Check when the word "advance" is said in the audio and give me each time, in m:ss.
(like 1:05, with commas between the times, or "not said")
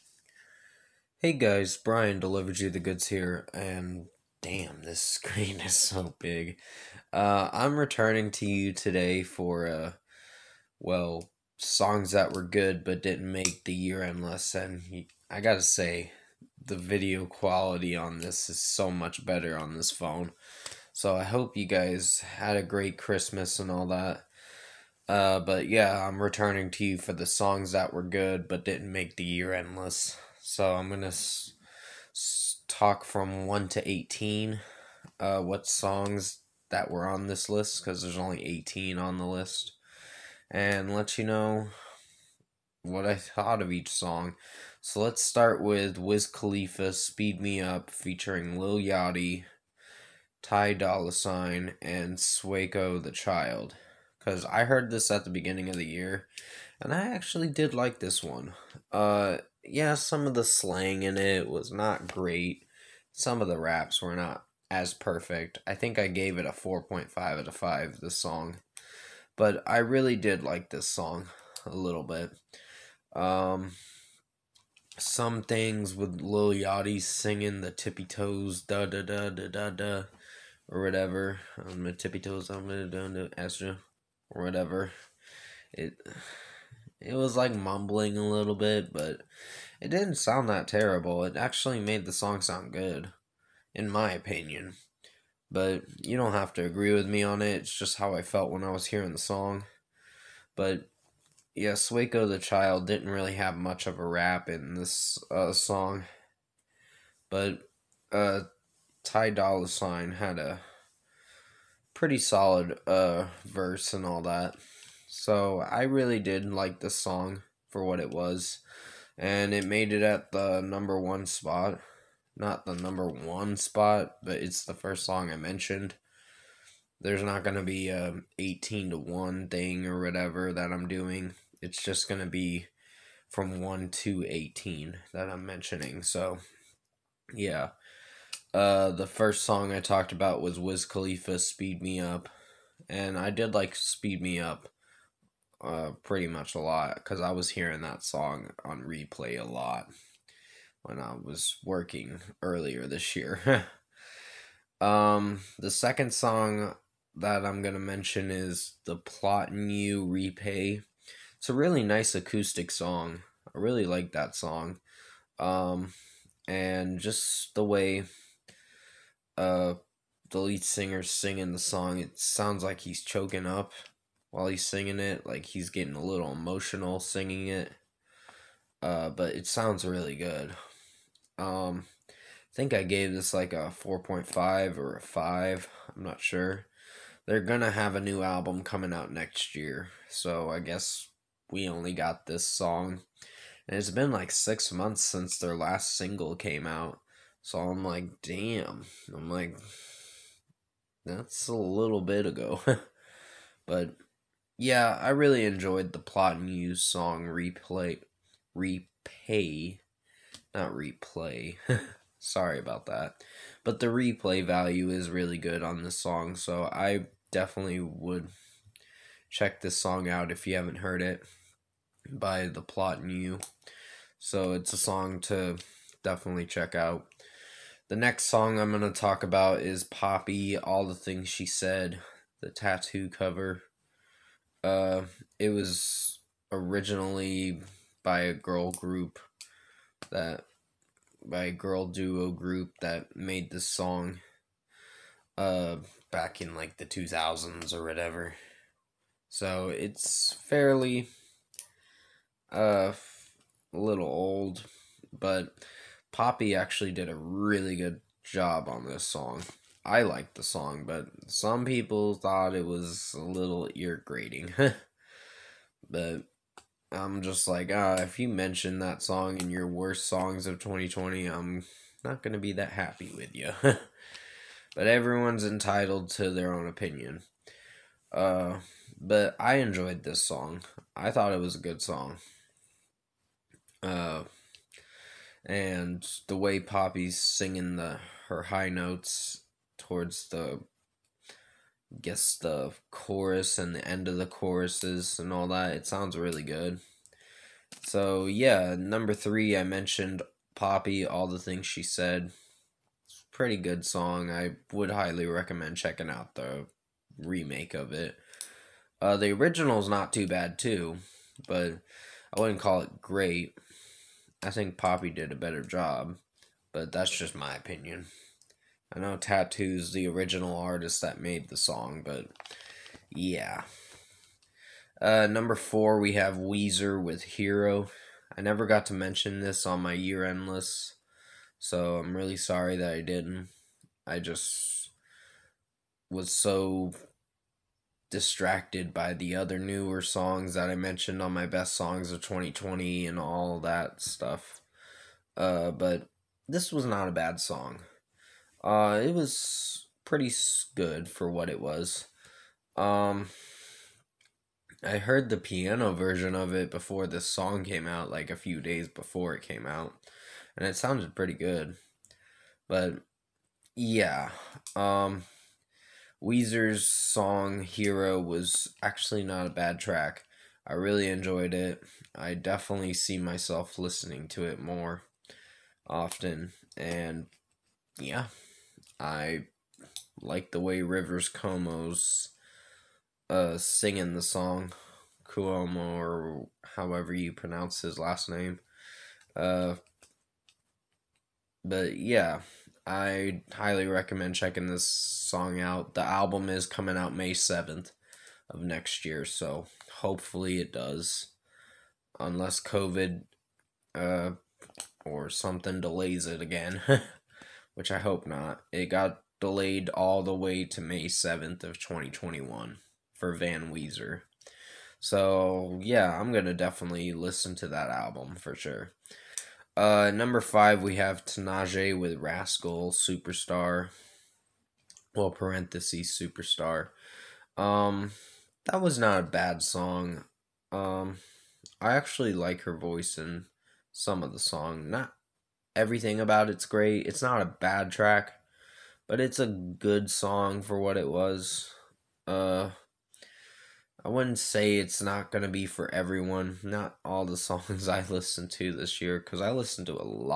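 not said.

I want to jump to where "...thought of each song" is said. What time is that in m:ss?
0:43.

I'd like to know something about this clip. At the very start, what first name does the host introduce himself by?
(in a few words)
Bryan.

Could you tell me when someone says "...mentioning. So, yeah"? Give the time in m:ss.
2:15.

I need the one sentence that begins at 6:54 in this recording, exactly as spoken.
So, yeah, I'm going to definitely listen to that album for sure.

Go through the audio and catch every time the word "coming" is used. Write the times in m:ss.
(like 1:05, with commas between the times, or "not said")
3:08, 6:36.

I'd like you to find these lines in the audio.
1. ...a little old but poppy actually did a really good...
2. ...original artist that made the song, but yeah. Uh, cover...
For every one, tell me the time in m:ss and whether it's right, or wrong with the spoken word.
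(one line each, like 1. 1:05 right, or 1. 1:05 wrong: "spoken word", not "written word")
1. 4:13 right
2. 5:20 wrong: "number", not "cover".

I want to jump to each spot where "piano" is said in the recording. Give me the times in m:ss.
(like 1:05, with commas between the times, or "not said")
5:55.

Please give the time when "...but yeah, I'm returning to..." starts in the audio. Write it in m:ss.
0:25.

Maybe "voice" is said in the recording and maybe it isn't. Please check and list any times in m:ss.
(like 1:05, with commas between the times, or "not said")
7:12.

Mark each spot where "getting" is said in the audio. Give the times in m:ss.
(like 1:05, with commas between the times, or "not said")
2:55.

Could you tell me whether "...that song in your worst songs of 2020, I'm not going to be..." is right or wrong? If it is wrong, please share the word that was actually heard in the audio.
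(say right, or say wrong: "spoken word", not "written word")
right.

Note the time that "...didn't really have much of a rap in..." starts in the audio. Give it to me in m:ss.
1:42.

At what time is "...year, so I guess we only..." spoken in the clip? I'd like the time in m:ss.
3:09.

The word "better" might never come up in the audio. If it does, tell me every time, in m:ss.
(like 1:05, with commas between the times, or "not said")
0:19, 5:15.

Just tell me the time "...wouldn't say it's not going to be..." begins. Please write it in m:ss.
7:24.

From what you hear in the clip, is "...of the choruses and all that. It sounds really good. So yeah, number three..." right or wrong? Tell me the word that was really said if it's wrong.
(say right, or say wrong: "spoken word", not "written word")
right.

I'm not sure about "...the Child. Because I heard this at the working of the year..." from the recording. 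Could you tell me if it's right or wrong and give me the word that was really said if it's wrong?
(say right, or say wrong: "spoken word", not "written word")
wrong: "beginning", not "working".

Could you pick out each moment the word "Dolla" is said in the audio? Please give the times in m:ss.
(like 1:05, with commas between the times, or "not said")
0:50, 1:49.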